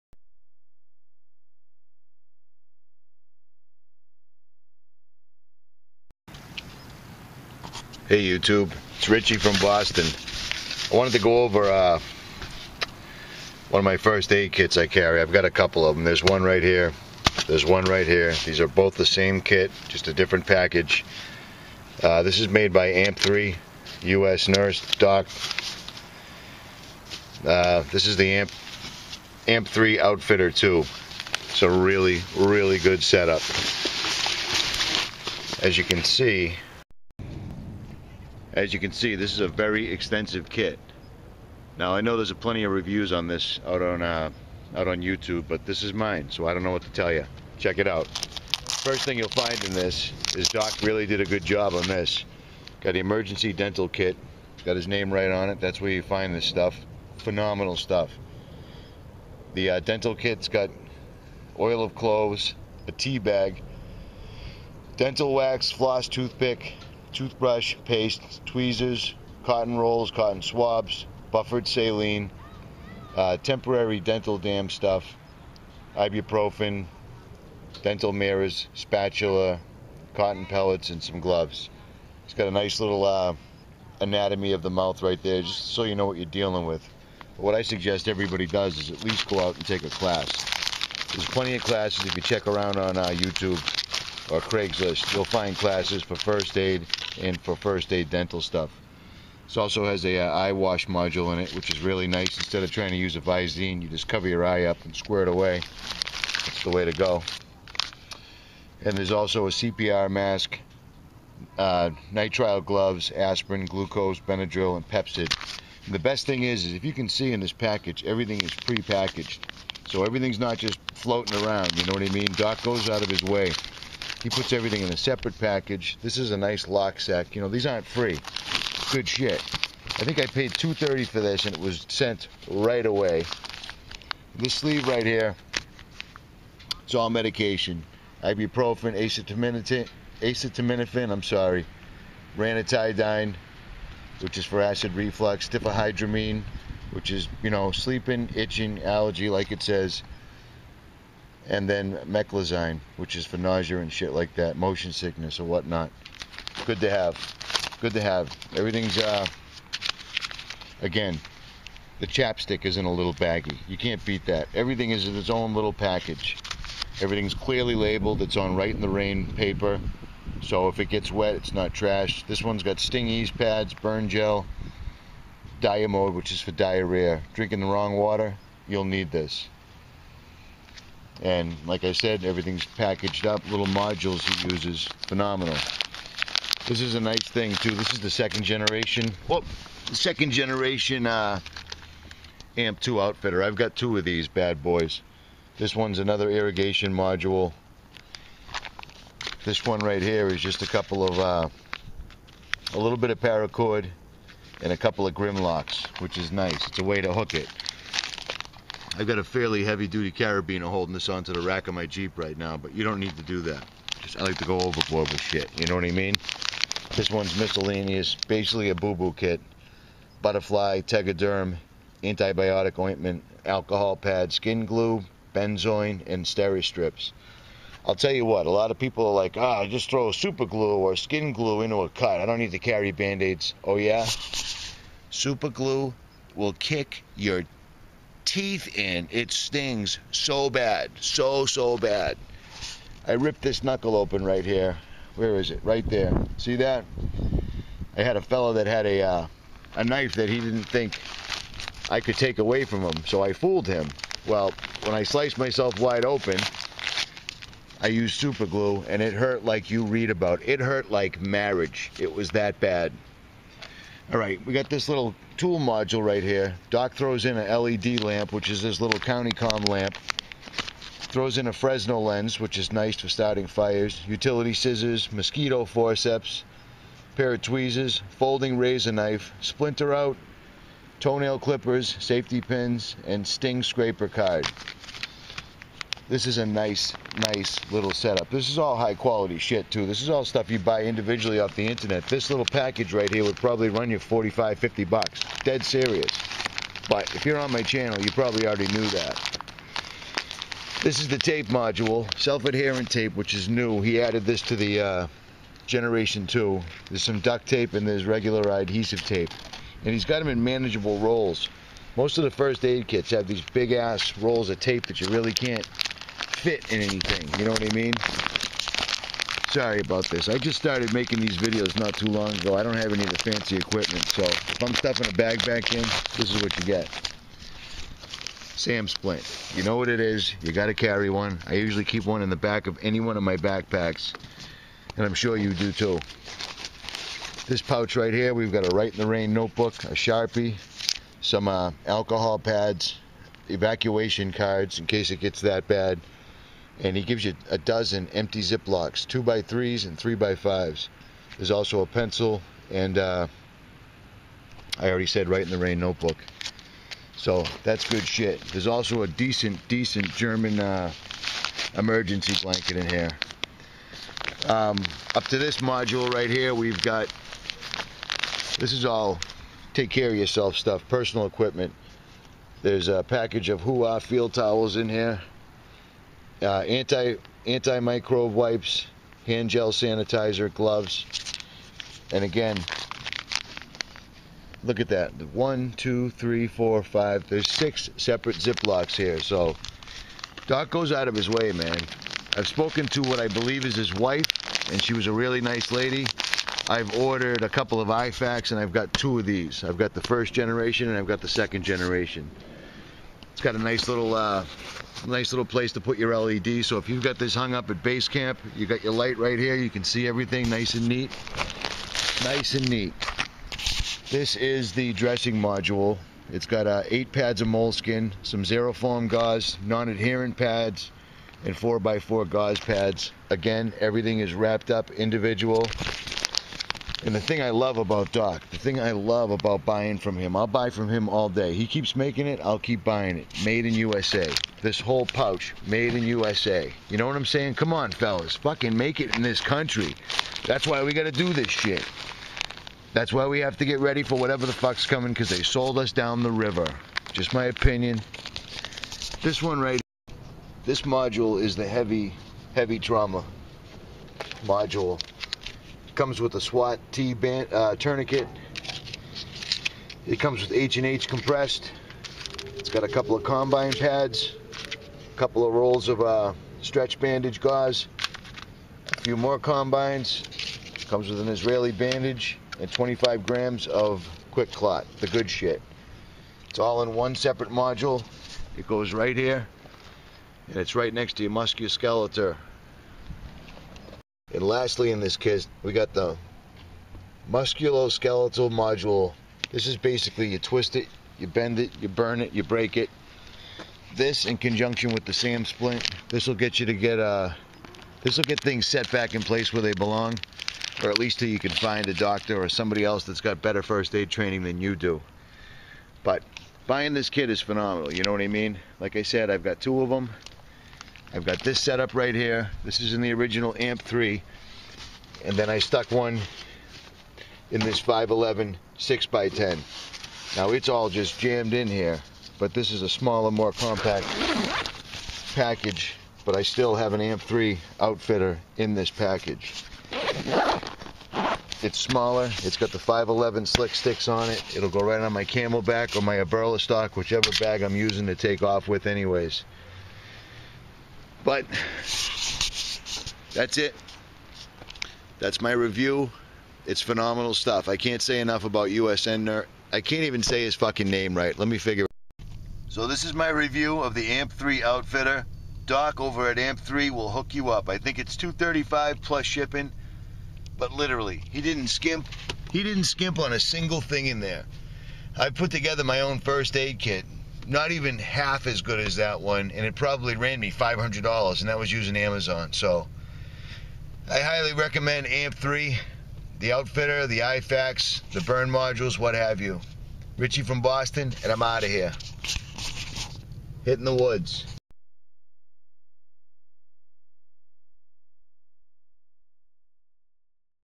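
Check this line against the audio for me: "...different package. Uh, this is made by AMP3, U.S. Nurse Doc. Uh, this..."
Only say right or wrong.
right.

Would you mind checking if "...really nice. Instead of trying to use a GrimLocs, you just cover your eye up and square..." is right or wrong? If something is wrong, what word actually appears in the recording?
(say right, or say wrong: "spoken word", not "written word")
wrong: "Visine", not "GrimLocs".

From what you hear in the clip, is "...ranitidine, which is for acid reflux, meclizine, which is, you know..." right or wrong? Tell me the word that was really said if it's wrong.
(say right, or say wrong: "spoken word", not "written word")
wrong: "diphenhydramine", not "meclizine".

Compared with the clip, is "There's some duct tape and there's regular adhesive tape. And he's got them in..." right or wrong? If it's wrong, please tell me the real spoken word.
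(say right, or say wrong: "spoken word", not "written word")
right.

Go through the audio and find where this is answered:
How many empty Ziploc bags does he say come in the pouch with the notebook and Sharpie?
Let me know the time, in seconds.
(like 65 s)
347 s.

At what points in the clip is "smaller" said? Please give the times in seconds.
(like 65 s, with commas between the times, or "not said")
522 s, 531 s.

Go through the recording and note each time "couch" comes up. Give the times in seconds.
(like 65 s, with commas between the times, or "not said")
not said.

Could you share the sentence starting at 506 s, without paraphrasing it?
But buying this kit is phenomenal, you know what I mean?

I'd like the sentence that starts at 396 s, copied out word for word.
I've ordered a couple of IFAKs, and I've got two of these.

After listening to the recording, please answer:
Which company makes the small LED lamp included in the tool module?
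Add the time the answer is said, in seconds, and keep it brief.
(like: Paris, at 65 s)
CountyComm, at 268 s.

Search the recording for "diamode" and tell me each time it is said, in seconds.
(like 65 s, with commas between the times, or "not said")
175 s.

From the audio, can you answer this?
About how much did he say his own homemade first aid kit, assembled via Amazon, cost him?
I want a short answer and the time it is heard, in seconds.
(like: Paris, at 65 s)
$500, at 570 s.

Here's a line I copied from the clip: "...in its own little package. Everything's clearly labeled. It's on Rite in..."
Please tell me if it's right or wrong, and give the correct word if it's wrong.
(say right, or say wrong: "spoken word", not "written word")
right.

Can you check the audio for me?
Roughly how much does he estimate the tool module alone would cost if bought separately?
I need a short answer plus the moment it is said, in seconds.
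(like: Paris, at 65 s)
$45 to $50, at 293 s.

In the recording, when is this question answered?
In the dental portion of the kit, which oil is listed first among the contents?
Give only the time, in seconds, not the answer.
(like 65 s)
61 s.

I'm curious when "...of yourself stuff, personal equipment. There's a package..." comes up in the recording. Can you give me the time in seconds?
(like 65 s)
370 s.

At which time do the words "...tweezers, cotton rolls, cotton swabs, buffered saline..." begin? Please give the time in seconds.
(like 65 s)
68 s.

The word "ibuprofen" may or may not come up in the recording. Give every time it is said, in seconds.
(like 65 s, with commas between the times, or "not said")
75 s, 138 s.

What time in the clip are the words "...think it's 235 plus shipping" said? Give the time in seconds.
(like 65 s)
557 s.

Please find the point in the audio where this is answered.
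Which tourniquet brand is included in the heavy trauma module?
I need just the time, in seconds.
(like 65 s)
456 s.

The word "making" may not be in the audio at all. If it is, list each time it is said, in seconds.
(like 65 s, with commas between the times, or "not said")
320 s, 431 s.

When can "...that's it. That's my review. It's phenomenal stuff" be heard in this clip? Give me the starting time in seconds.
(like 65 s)
543 s.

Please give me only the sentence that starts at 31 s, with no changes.
It's a really, really good setup.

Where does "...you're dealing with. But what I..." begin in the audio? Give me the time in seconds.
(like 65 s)
86 s.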